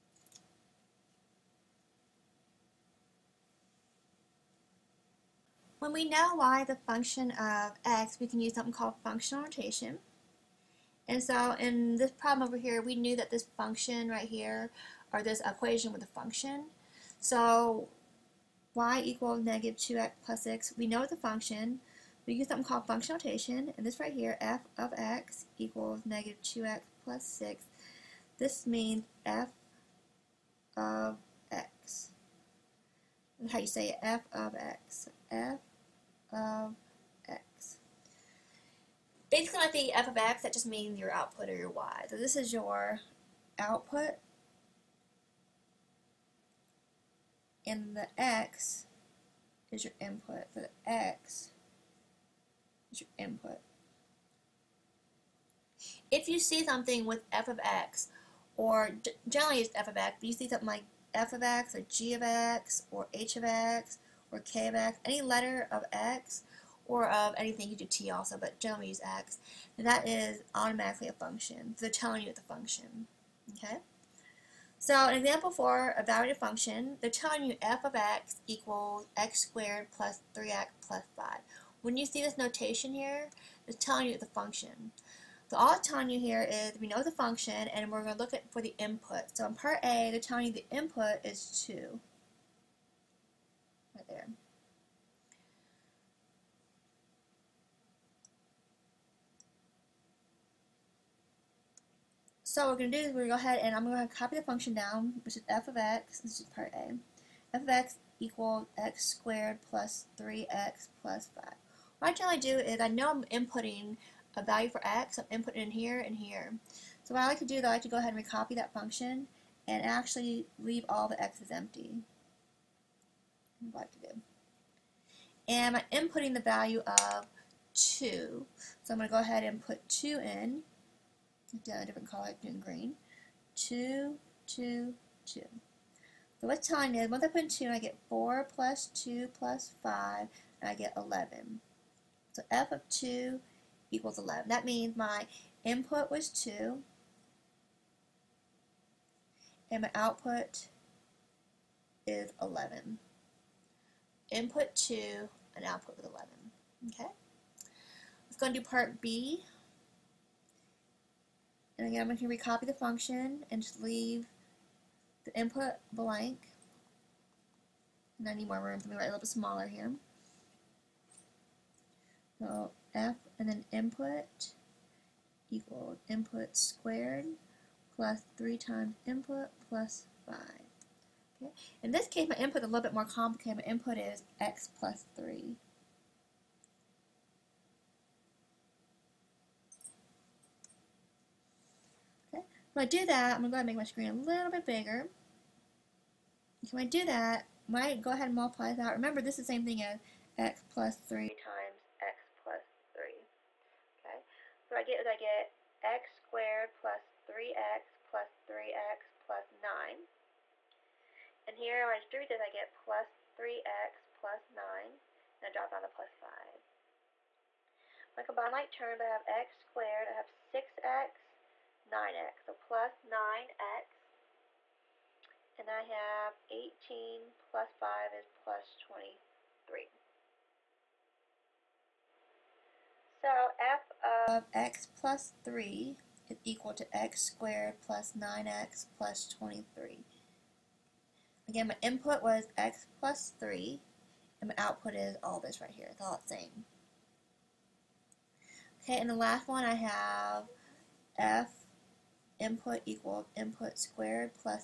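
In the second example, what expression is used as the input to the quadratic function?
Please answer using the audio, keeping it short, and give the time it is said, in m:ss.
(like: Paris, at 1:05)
x plus 3, at 3:03.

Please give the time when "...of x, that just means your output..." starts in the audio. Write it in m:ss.
0:40.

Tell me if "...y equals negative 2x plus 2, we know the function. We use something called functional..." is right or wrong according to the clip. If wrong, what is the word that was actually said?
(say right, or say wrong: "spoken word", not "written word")
wrong: "6", not "2".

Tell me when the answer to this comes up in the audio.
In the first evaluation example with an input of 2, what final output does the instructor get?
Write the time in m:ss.
2:20.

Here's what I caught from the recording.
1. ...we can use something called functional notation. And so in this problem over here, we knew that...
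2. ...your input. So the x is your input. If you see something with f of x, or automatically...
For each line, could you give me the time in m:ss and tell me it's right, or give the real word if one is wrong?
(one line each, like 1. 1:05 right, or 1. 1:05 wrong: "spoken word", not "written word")
1. 0:08 right
2. 0:49 wrong: "generally", not "automatically".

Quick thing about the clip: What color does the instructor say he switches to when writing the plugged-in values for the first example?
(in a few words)
green.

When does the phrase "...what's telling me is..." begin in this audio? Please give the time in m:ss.
2:16.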